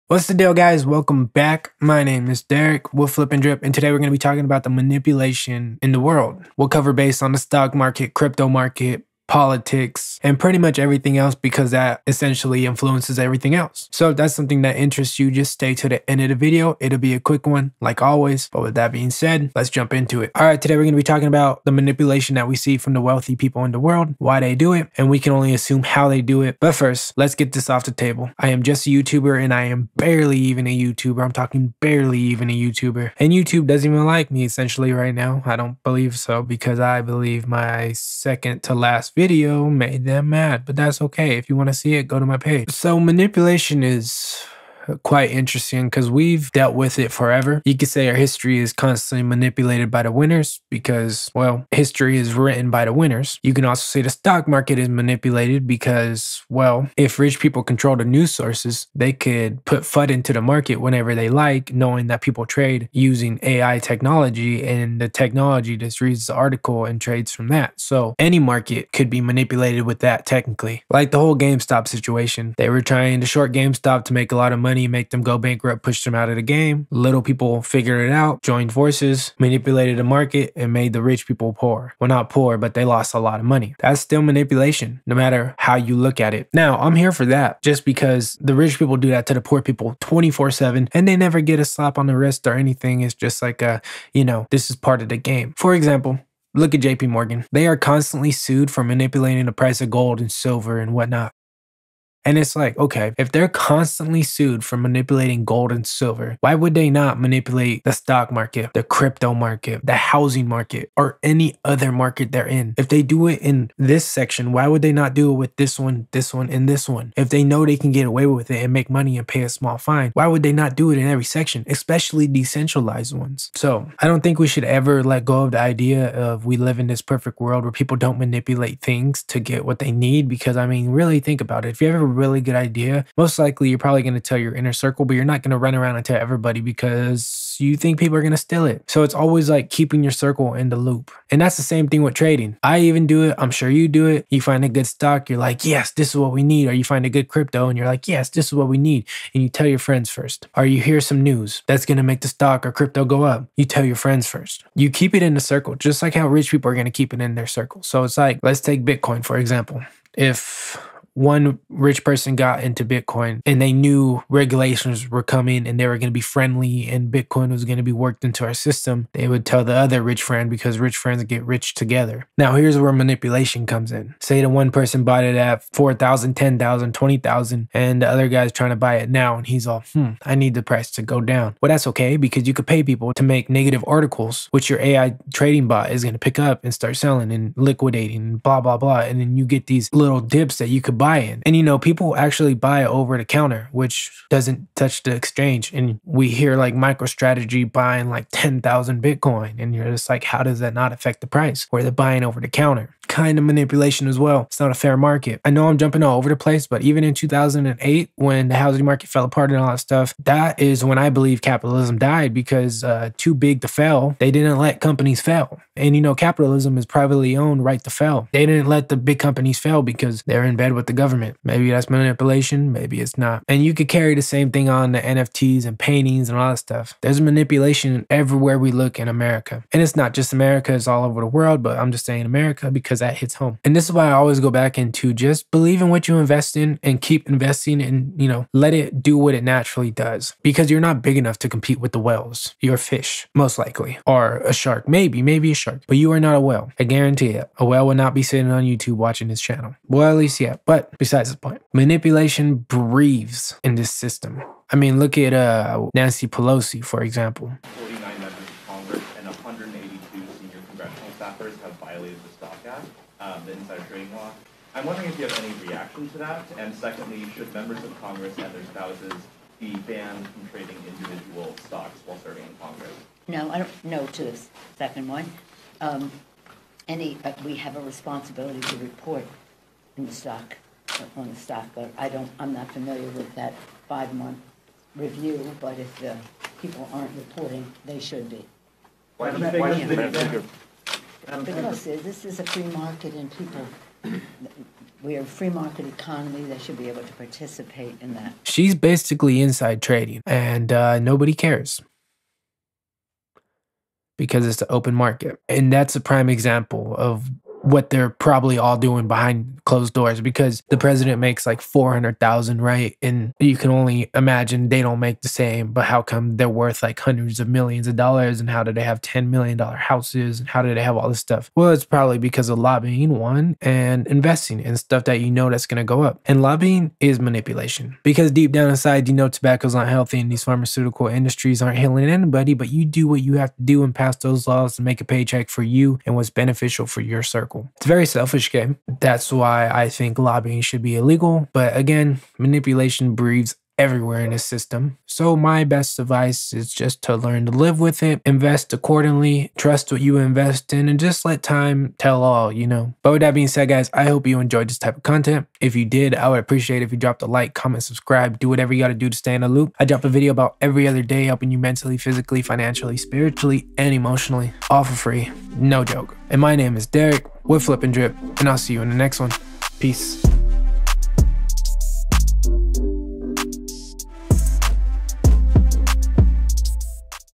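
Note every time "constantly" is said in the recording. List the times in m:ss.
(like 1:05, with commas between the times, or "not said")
0:48, 1:37, 1:43.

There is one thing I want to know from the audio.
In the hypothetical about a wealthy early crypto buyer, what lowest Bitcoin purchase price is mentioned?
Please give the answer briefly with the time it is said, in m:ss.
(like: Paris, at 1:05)
4,000, at 2:55.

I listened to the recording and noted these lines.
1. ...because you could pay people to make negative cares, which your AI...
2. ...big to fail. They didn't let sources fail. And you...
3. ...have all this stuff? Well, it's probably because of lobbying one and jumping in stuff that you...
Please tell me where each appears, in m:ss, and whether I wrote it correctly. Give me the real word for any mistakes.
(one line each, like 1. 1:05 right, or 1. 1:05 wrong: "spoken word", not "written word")
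1. 3:02 wrong: "articles", not "cares"
2. 3:33 wrong: "companies", not "sources"
3. 5:20 wrong: "investing", not "jumping".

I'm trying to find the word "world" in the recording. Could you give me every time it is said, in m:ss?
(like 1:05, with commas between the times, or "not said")
0:06, 0:23, 2:07, 3:51.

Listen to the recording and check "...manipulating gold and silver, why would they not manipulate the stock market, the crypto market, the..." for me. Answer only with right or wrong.
right.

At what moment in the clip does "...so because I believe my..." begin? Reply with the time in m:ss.
0:36.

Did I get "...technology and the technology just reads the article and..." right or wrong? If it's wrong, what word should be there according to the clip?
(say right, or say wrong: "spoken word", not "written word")
right.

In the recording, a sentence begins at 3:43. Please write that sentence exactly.
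And you could carry the same thing on the NFTs and paintings and all that stuff.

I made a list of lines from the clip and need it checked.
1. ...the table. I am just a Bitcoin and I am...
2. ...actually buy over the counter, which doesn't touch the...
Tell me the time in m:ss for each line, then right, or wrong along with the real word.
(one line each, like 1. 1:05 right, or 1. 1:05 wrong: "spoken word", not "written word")
1. 0:27 wrong: "YouTuber", not "Bitcoin"
2. 3:12 right.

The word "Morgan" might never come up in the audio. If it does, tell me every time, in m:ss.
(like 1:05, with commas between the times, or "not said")
1:37.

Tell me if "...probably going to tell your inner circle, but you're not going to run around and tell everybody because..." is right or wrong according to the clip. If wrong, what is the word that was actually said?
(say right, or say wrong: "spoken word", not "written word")
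right.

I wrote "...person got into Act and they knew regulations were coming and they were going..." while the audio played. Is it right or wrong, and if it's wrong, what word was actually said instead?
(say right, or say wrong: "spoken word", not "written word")
wrong: "Bitcoin", not "Act".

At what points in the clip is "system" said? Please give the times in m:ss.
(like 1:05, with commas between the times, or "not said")
2:48, 4:13, 5:44.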